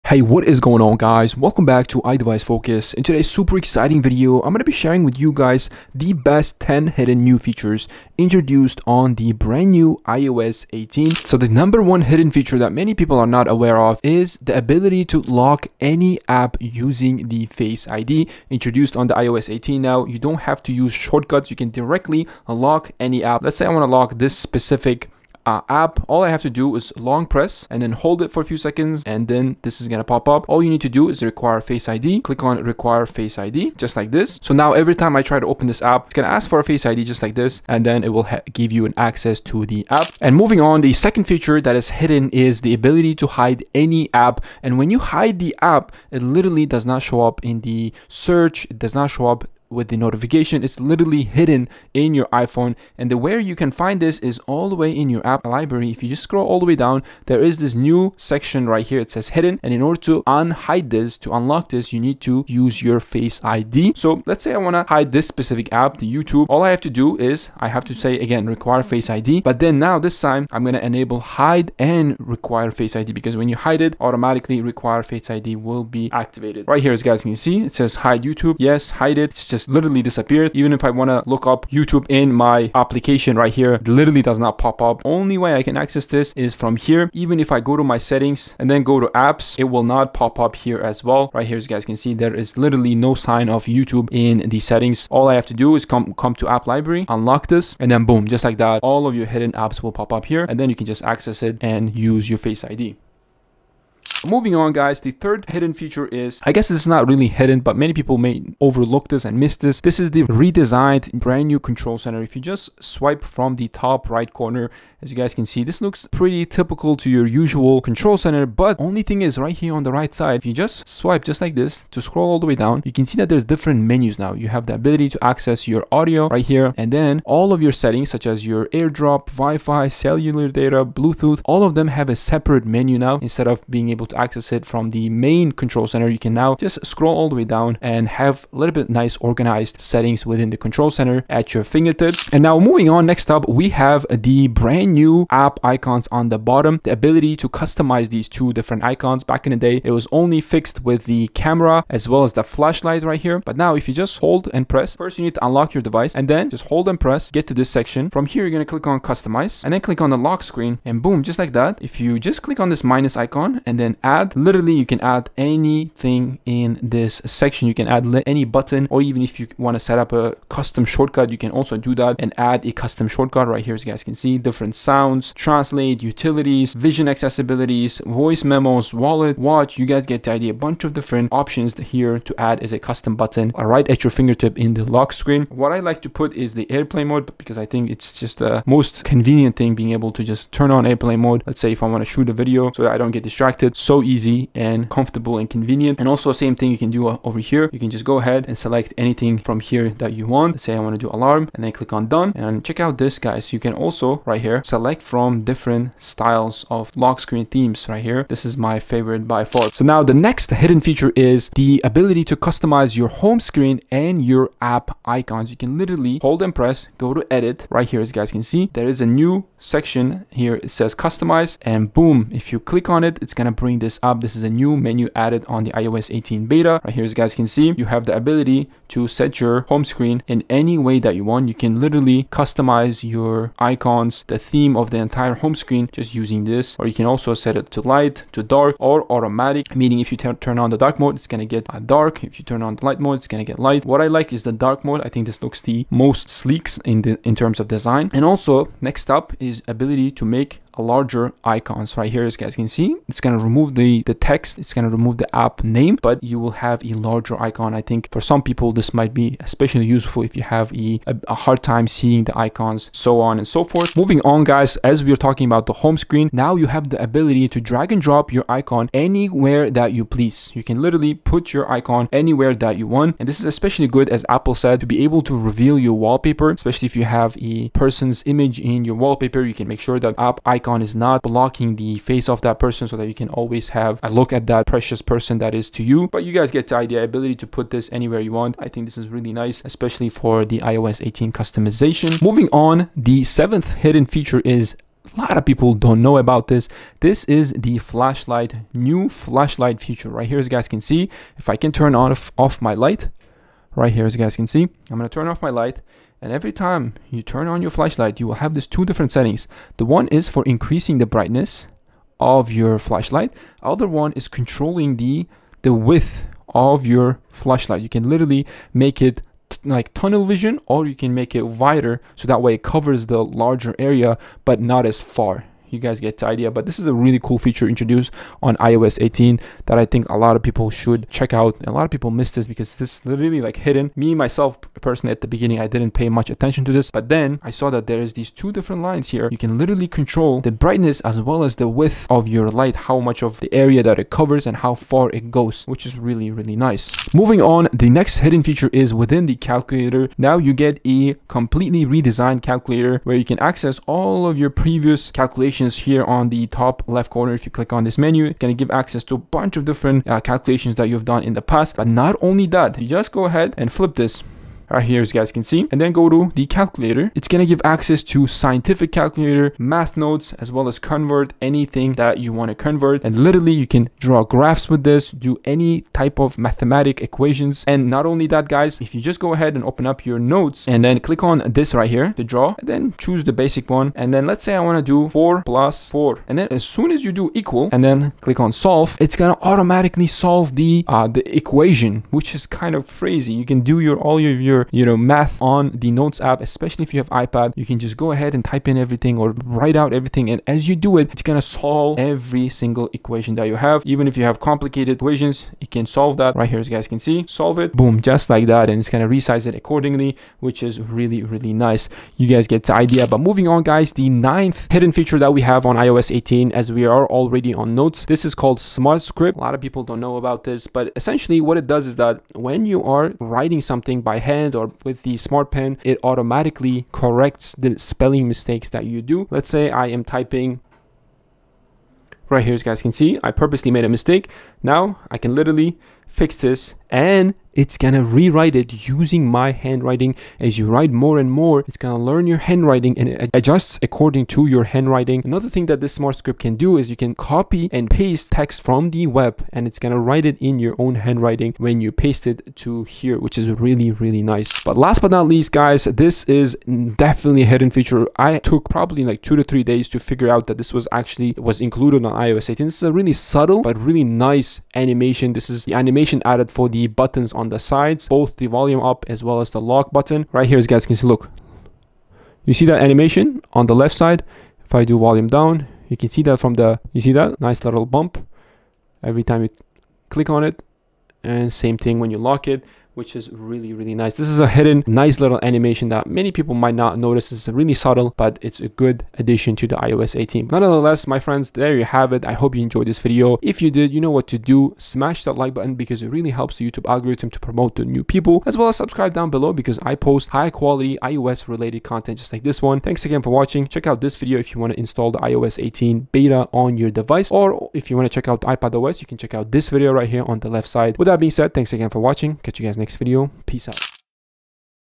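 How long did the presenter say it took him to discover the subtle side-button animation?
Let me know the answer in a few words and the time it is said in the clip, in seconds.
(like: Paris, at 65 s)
2 to 3 days, at 459 s.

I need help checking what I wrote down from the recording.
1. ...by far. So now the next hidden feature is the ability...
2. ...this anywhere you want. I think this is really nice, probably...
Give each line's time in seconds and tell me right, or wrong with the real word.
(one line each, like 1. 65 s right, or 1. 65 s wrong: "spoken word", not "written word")
1. 209 s right
2. 287 s wrong: "especially", not "probably".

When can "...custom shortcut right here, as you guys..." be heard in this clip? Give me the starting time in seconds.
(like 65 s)
172 s.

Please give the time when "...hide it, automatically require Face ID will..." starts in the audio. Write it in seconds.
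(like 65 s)
73 s.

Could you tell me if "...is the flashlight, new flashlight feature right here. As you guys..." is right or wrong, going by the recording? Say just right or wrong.
right.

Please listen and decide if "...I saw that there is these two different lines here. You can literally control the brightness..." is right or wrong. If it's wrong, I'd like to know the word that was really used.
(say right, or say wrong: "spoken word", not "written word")
right.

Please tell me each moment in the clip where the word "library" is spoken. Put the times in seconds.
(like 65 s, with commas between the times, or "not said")
55 s, 96 s.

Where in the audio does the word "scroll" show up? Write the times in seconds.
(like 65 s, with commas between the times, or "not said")
56 s, 121 s, 136 s.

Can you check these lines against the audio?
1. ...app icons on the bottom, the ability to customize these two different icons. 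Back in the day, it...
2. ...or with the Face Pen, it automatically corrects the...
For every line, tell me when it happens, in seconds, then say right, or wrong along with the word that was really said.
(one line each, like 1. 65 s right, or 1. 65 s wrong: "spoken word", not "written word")
1. 145 s right
2. 424 s wrong: "Smart", not "Face".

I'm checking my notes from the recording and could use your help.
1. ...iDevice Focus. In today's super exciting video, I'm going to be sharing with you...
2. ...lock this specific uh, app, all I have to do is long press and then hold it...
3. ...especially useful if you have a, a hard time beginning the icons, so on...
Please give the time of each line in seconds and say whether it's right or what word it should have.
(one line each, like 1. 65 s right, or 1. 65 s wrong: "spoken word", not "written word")
1. 2 s right
2. 23 s right
3. 259 s wrong: "seeing", not "beginning".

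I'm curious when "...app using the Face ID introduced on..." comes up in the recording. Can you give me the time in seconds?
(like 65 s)
16 s.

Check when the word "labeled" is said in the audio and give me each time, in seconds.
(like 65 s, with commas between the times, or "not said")
not said.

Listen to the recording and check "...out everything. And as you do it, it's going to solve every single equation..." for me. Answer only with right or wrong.
right.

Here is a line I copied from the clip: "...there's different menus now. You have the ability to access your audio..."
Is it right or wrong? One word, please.
right.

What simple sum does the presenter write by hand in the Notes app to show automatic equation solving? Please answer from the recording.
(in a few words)
4 plus 4.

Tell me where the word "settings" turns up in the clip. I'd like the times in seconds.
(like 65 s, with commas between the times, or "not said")
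87 s, 94 s, 127 s, 139 s, 309 s.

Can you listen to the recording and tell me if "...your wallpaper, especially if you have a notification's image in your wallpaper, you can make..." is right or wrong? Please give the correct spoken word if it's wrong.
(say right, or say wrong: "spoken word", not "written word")
wrong: "person", not "notification".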